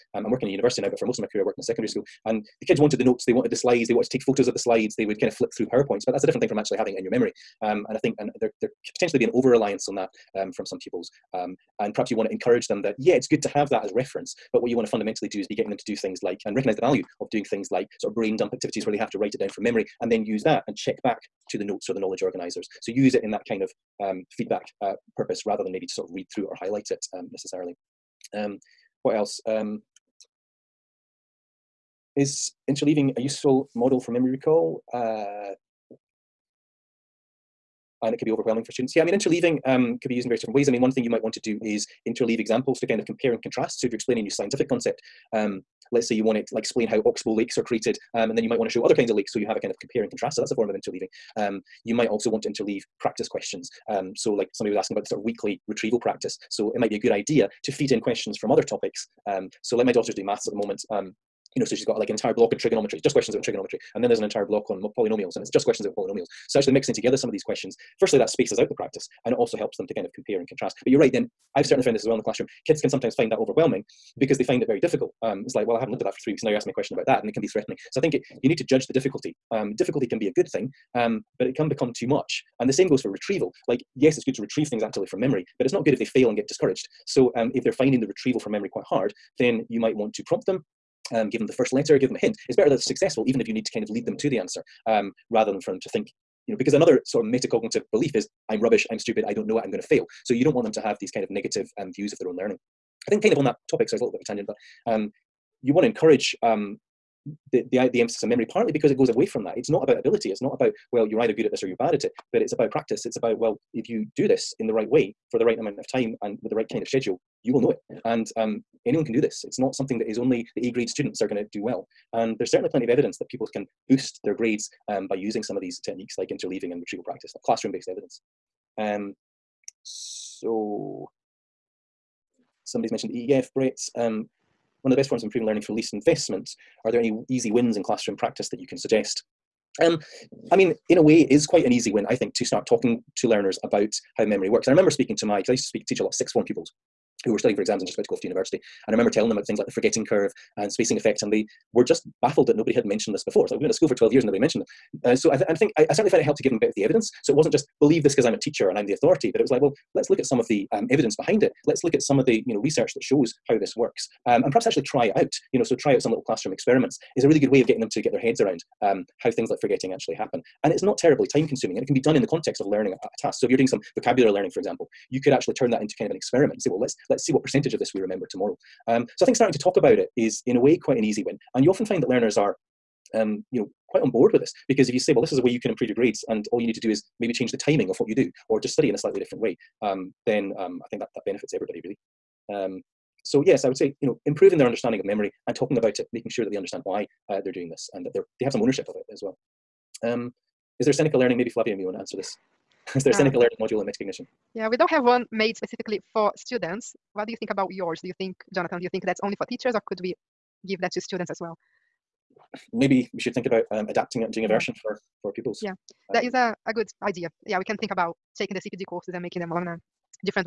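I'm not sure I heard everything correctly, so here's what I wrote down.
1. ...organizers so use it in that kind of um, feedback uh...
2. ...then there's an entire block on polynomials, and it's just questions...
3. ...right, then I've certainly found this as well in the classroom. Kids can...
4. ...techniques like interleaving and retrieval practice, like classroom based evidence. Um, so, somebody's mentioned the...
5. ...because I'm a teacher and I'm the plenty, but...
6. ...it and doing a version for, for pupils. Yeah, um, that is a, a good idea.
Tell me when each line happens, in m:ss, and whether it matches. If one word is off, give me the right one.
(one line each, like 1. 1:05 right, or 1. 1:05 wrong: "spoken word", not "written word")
1. 0:22 right
2. 1:04 right
3. 1:10 right
4. 2:05 right
5. 2:38 wrong: "authority", not "plenty"
6. 3:34 right.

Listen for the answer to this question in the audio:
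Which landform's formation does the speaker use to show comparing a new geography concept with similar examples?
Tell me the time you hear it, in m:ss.
0:47.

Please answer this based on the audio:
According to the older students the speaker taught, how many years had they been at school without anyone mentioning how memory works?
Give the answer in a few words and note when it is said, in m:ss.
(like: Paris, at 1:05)
12, at 2:33.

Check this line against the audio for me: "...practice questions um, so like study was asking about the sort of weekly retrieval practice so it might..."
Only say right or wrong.
wrong.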